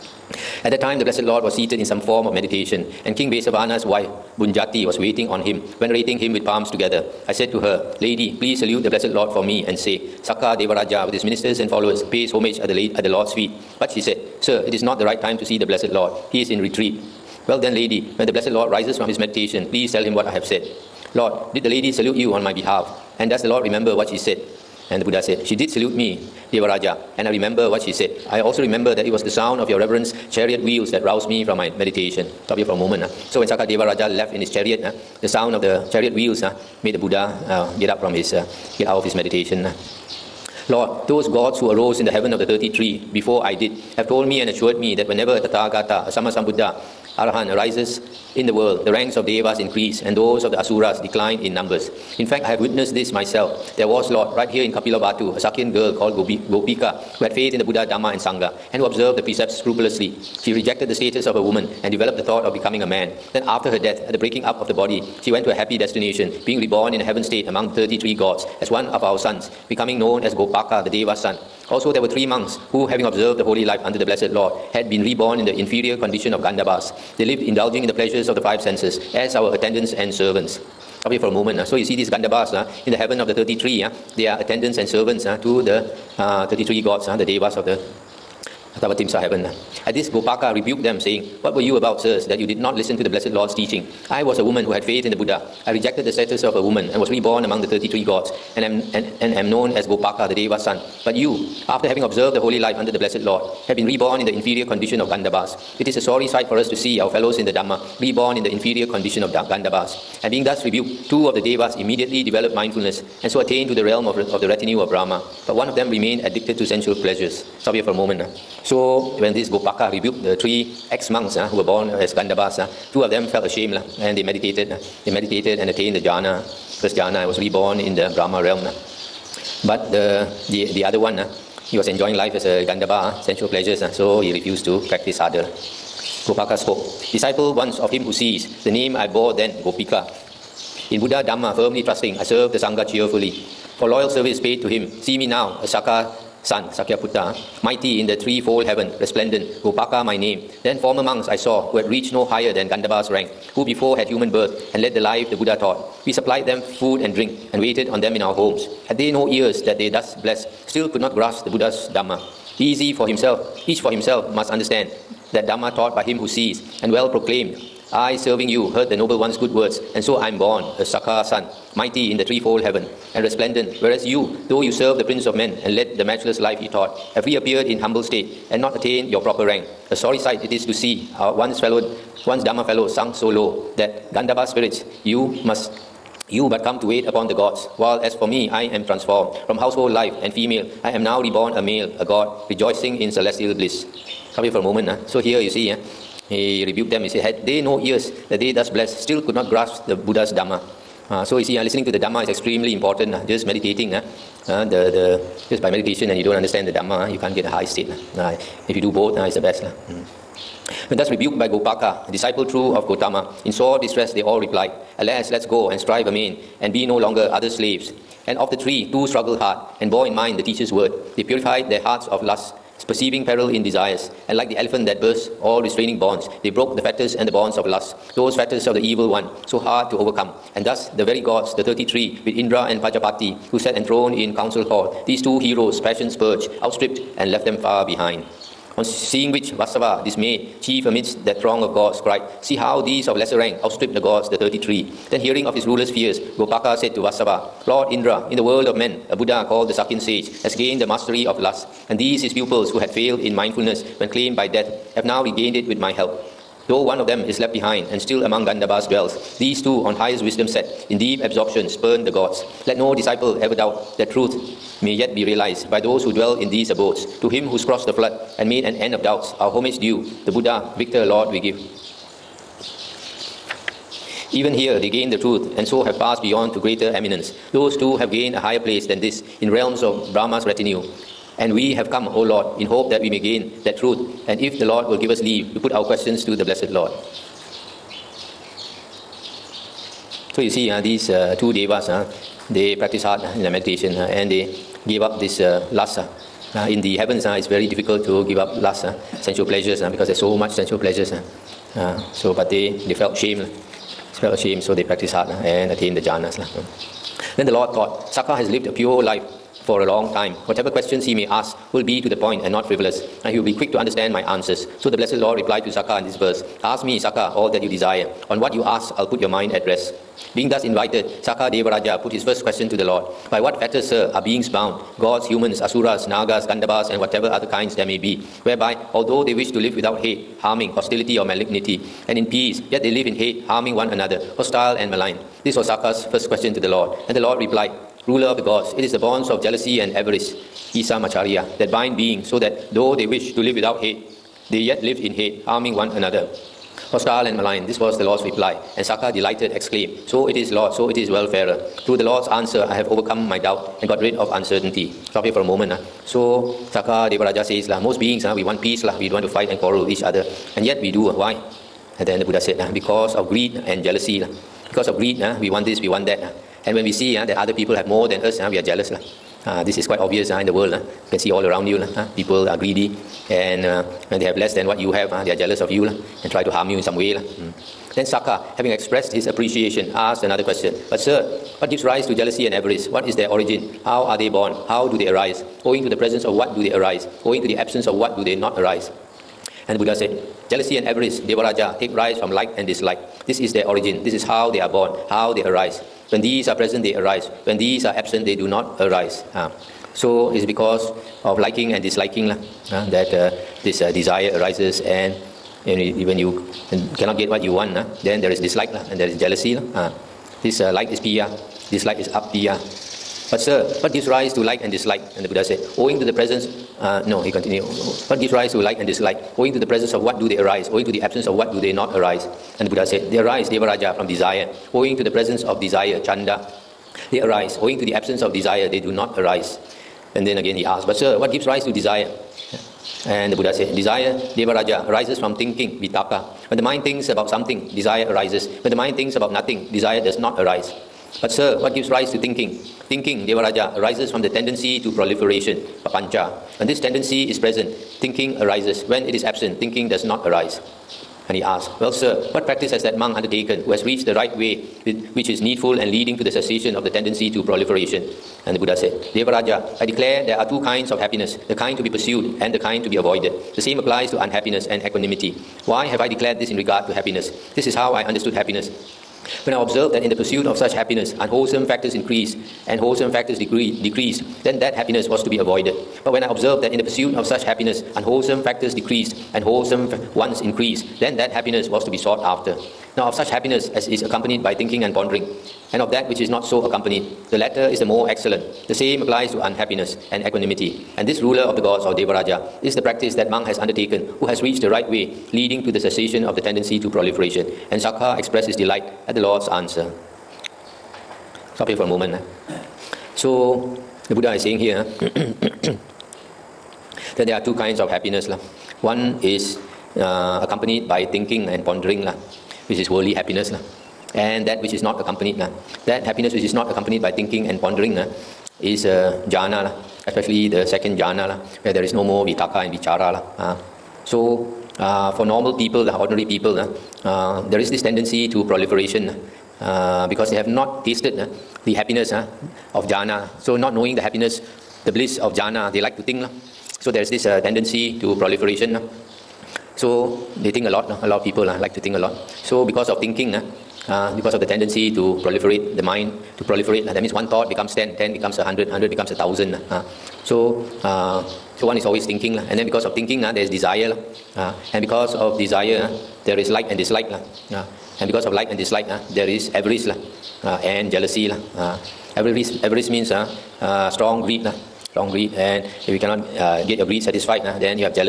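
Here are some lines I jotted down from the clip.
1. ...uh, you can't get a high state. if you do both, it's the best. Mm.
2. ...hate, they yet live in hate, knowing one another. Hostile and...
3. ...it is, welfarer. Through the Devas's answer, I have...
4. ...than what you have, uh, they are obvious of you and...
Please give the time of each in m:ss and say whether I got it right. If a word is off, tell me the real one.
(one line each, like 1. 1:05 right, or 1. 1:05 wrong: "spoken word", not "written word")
1. 3:27 right
2. 5:43 wrong: "harming", not "knowing"
3. 5:50 wrong: "Lord", not "Devas"
4. 6:14 wrong: "jealous", not "obvious".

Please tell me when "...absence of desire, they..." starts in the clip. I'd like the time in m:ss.
7:07.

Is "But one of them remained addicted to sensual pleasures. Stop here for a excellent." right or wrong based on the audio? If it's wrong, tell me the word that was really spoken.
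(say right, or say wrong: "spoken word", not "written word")
wrong: "moment", not "excellent".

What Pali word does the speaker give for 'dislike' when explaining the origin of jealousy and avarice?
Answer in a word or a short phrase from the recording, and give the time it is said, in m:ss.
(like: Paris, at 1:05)
apiya, at 6:52.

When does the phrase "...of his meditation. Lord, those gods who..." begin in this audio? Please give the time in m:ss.
0:39.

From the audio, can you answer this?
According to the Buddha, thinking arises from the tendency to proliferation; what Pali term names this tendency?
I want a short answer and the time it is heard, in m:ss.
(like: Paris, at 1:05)
papancha, at 7:25.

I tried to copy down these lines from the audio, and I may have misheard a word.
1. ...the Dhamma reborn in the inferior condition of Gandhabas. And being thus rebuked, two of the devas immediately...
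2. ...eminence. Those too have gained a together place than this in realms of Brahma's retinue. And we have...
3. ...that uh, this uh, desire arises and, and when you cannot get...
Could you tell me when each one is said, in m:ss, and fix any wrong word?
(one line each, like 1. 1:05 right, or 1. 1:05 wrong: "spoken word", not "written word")
1. 1:47 right
2. 4:36 wrong: "higher", not "together"
3. 6:42 right.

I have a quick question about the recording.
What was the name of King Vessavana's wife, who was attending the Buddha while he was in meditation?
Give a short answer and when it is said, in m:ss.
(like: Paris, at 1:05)
Bhunjati, at 0:04.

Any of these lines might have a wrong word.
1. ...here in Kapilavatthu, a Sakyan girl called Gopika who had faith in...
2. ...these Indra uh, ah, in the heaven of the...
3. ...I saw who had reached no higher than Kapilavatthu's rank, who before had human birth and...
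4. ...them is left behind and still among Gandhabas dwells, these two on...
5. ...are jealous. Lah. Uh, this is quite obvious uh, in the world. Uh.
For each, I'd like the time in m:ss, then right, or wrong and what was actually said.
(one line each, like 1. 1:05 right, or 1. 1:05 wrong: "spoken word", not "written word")
1. 0:54 right
2. 1:21 wrong: "Gandhabas", not "Indra"
3. 2:31 wrong: "Gandhabba", not "Kapilavatthu"
4. 4:17 right
5. 6:08 right.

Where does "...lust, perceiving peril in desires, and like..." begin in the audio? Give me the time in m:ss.
3:42.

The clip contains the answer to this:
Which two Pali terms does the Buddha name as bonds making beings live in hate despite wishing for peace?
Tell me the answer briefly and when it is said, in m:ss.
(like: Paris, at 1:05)
Issa Macchariya, at 5:40.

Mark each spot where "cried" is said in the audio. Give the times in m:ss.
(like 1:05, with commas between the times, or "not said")
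4:02.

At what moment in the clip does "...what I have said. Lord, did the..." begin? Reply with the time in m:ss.
0:20.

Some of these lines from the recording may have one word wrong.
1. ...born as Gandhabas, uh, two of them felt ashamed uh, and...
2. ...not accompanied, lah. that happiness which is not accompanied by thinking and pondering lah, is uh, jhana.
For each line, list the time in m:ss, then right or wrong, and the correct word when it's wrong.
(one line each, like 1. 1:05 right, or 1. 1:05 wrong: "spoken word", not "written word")
1. 2:01 right
2. 8:34 right.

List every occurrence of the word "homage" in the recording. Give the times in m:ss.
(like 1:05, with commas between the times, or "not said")
0:12, 4:29.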